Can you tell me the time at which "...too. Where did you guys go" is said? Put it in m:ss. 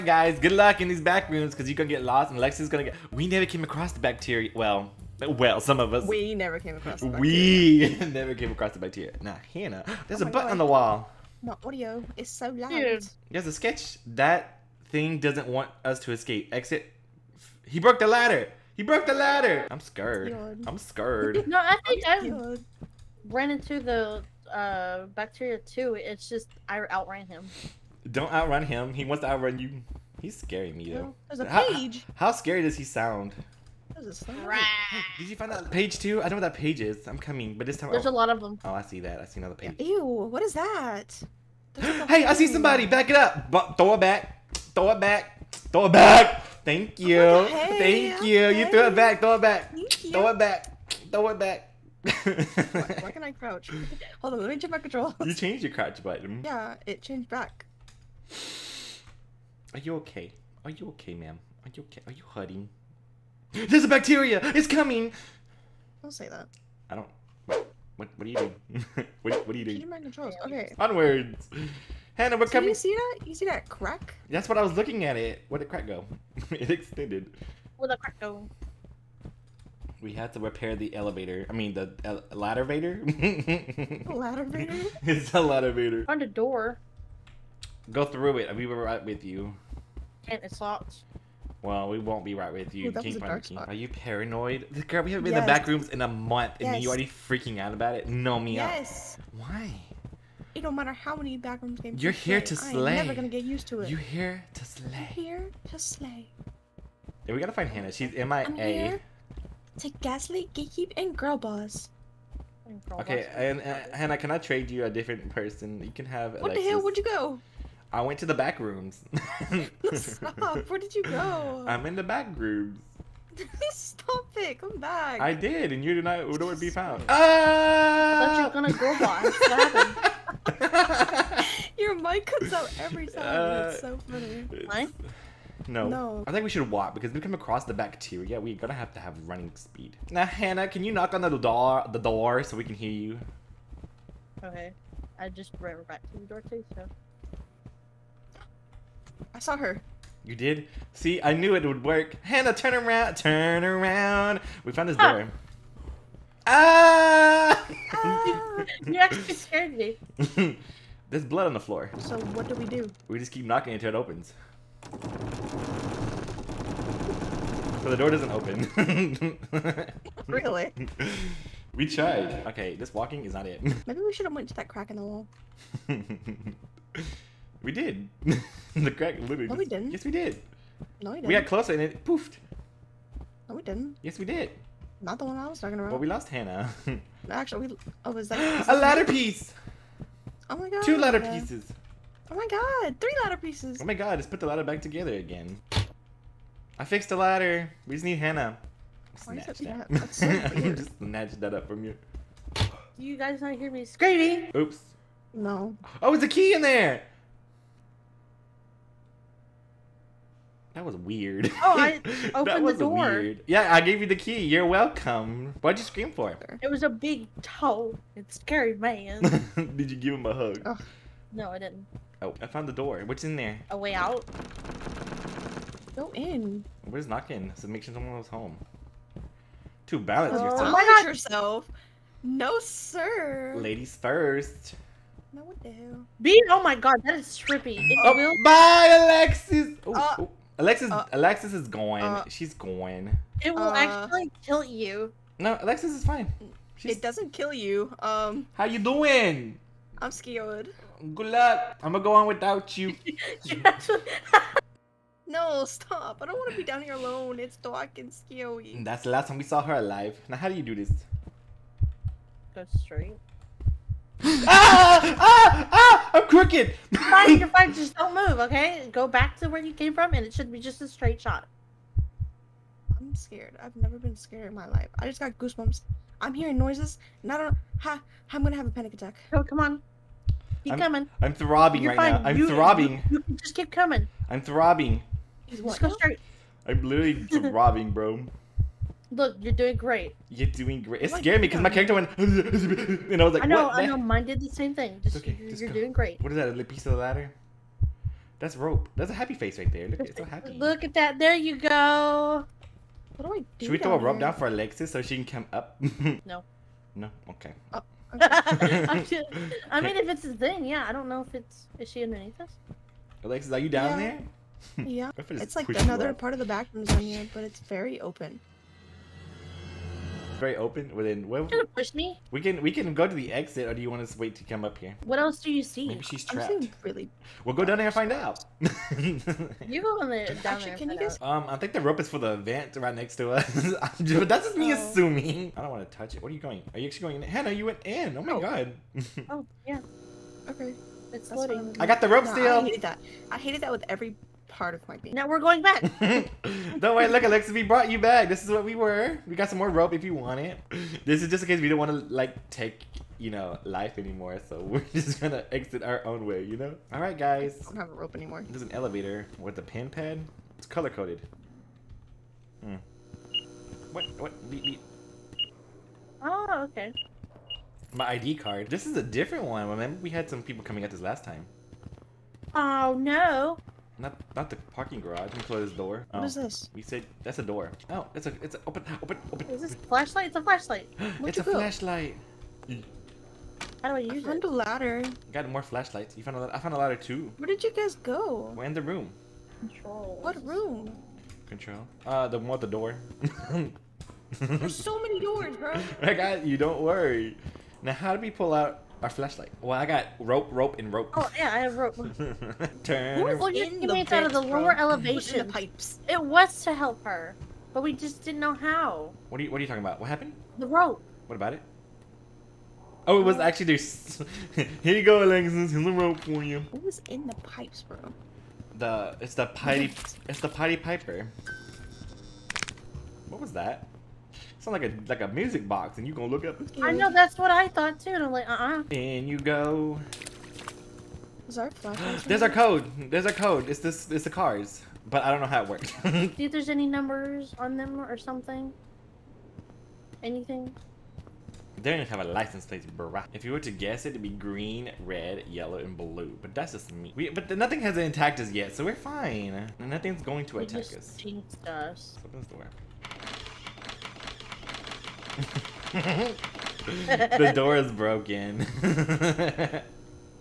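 6:26.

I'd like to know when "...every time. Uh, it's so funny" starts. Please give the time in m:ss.
2:12.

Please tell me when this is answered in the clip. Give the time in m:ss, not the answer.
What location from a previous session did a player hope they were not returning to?
6:14.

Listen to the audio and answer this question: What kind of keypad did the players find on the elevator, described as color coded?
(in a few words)
pin pad.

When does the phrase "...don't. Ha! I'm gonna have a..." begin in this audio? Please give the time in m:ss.
4:37.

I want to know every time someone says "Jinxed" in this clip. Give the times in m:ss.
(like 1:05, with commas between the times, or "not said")
7:31.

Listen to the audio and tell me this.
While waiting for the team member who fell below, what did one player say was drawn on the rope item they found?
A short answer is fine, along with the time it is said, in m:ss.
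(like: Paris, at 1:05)
happy face, at 4:59.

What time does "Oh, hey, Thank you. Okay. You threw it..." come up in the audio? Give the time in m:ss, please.
0:47.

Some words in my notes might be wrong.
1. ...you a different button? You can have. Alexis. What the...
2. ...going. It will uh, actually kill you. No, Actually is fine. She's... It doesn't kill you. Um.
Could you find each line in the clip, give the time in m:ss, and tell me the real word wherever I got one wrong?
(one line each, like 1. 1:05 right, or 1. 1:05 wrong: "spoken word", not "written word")
1. 1:54 wrong: "person", not "button"
2. 4:02 wrong: "Alexis", not "Actually".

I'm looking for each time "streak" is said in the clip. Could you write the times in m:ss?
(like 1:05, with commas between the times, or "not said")
not said.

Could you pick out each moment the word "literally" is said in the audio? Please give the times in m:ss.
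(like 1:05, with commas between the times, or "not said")
2:59, 4:46.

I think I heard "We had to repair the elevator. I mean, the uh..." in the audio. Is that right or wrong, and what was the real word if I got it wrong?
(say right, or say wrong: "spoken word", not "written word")
right.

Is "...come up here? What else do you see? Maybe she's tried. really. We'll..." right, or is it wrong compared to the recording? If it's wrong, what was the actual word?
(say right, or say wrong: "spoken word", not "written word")
wrong: "trapped", not "tried".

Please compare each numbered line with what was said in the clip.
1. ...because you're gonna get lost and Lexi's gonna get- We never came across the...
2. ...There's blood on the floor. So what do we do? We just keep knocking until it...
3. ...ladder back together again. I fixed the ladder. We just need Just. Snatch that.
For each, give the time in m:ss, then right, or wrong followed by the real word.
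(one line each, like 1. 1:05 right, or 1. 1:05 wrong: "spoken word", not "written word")
1. 0:01 right
2. 2:41 right
3. 3:14 wrong: "Hannah", not "Just".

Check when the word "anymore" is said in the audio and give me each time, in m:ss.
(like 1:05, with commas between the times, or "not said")
5:53, 5:58.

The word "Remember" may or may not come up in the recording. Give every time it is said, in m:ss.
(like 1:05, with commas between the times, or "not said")
6:09.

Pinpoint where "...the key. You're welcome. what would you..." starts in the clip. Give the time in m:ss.
3:34.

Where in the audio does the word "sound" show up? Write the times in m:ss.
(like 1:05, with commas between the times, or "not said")
0:32, 7:04.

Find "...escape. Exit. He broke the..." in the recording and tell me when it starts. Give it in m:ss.
0:16.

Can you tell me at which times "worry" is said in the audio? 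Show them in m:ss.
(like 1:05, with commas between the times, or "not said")
5:46, 6:36.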